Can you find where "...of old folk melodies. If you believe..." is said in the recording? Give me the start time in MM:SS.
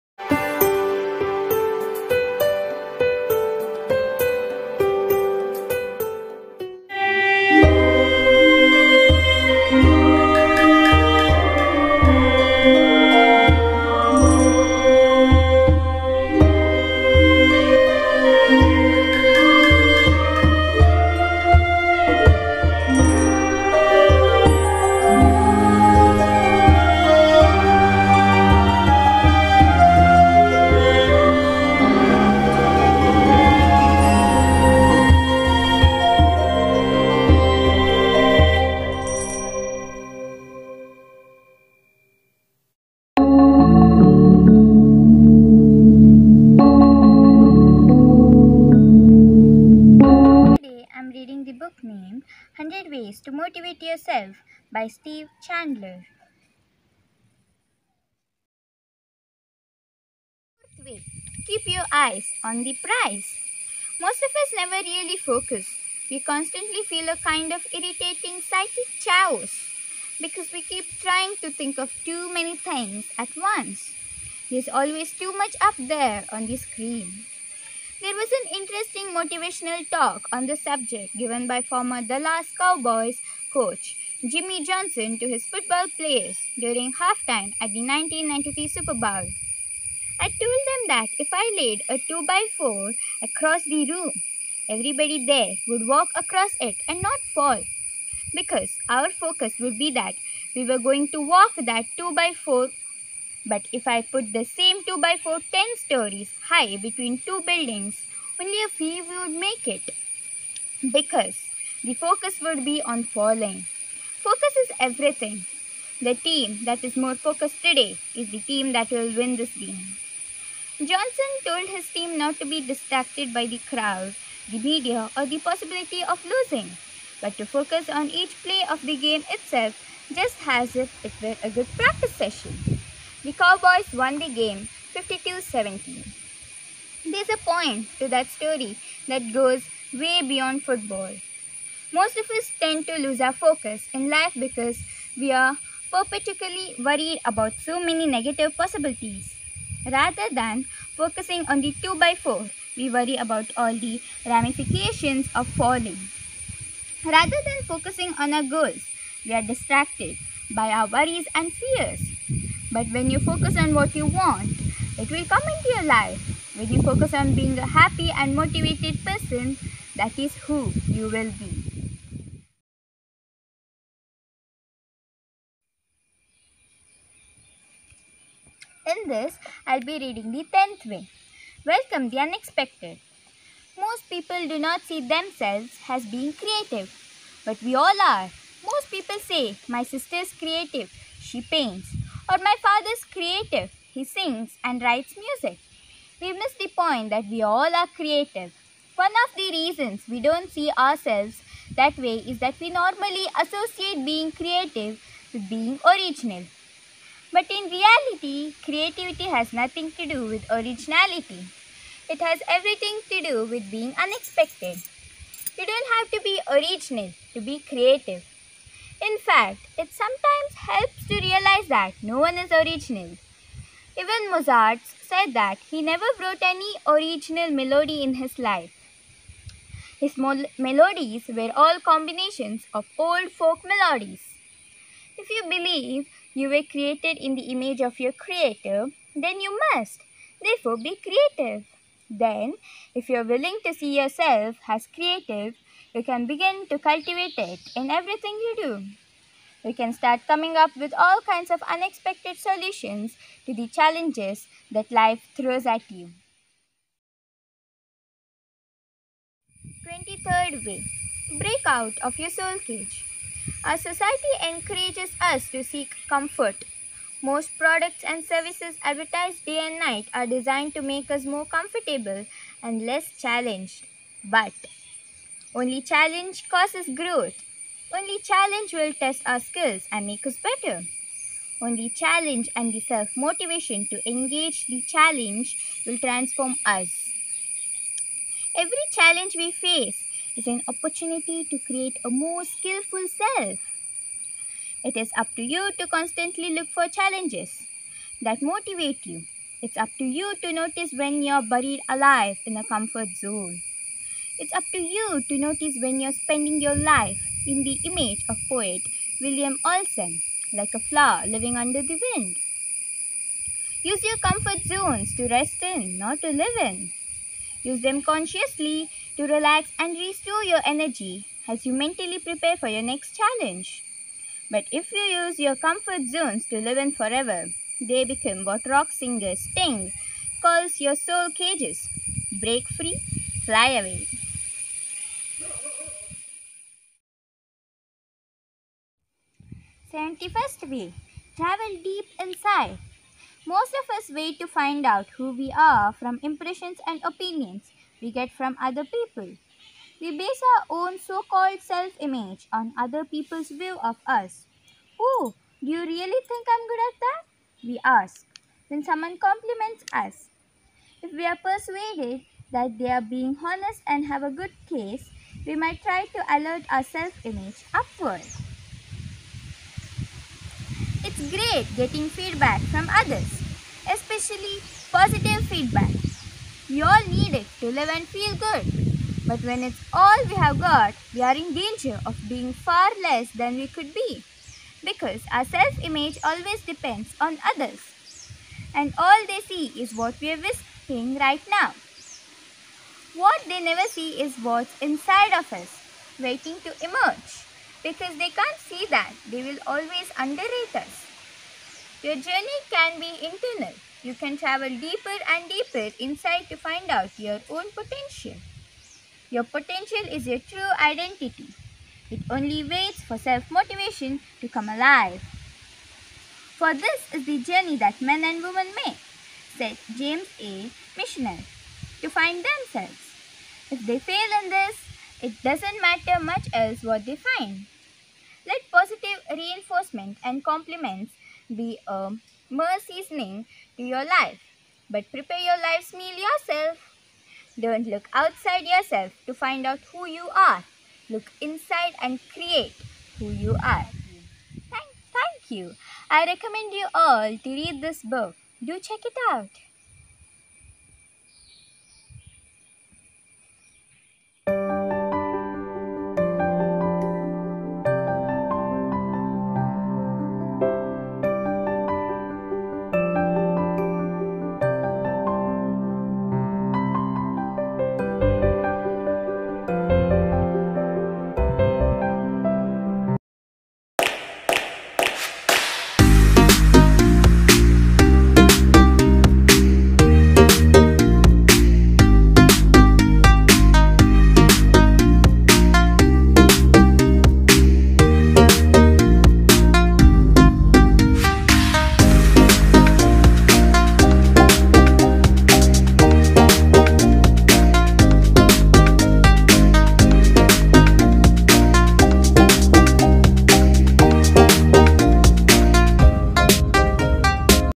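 03:52.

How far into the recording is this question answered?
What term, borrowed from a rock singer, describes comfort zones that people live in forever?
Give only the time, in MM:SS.
05:30.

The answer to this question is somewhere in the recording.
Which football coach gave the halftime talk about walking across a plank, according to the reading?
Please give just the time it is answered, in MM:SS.
01:24.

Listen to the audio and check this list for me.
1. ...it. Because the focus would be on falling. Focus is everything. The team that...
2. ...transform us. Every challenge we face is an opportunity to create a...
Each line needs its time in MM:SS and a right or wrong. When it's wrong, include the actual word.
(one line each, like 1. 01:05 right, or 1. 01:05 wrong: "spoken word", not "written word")
1. 01:49 right
2. 04:45 right.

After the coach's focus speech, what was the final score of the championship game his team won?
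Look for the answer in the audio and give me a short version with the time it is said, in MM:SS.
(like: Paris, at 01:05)
52-17, at 02:14.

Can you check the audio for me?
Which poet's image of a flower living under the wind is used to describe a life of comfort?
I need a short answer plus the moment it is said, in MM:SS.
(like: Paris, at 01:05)
William Olsen, at 05:09.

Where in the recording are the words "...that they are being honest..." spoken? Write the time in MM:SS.
06:02.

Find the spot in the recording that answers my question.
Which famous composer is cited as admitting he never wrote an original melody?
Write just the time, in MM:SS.
03:44.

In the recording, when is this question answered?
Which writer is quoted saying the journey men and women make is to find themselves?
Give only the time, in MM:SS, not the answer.
06:59.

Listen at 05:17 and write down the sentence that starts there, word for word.
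Use them consciously to relax and restore your energy as you mentally prepare for your next challenge.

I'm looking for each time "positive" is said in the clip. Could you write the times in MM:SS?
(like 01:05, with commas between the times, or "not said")
06:14, 07:08.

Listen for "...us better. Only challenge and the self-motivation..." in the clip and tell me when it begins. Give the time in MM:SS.
04:40.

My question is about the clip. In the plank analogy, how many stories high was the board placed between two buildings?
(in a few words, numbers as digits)
10.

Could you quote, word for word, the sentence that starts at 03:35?
You don't have to be original to be creative.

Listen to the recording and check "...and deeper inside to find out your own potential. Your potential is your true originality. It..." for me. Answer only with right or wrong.
wrong.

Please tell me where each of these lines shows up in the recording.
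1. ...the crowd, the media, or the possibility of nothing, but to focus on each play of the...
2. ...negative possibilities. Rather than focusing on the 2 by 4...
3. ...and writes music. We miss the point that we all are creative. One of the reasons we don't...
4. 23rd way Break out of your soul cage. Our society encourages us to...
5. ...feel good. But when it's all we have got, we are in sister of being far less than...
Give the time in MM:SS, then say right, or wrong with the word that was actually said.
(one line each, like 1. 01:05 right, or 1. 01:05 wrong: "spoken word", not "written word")
1. 02:03 wrong: "losing", not "nothing"
2. 02:28 right
3. 03:14 right
4. 04:19 right
5. 06:18 wrong: "danger", not "sister".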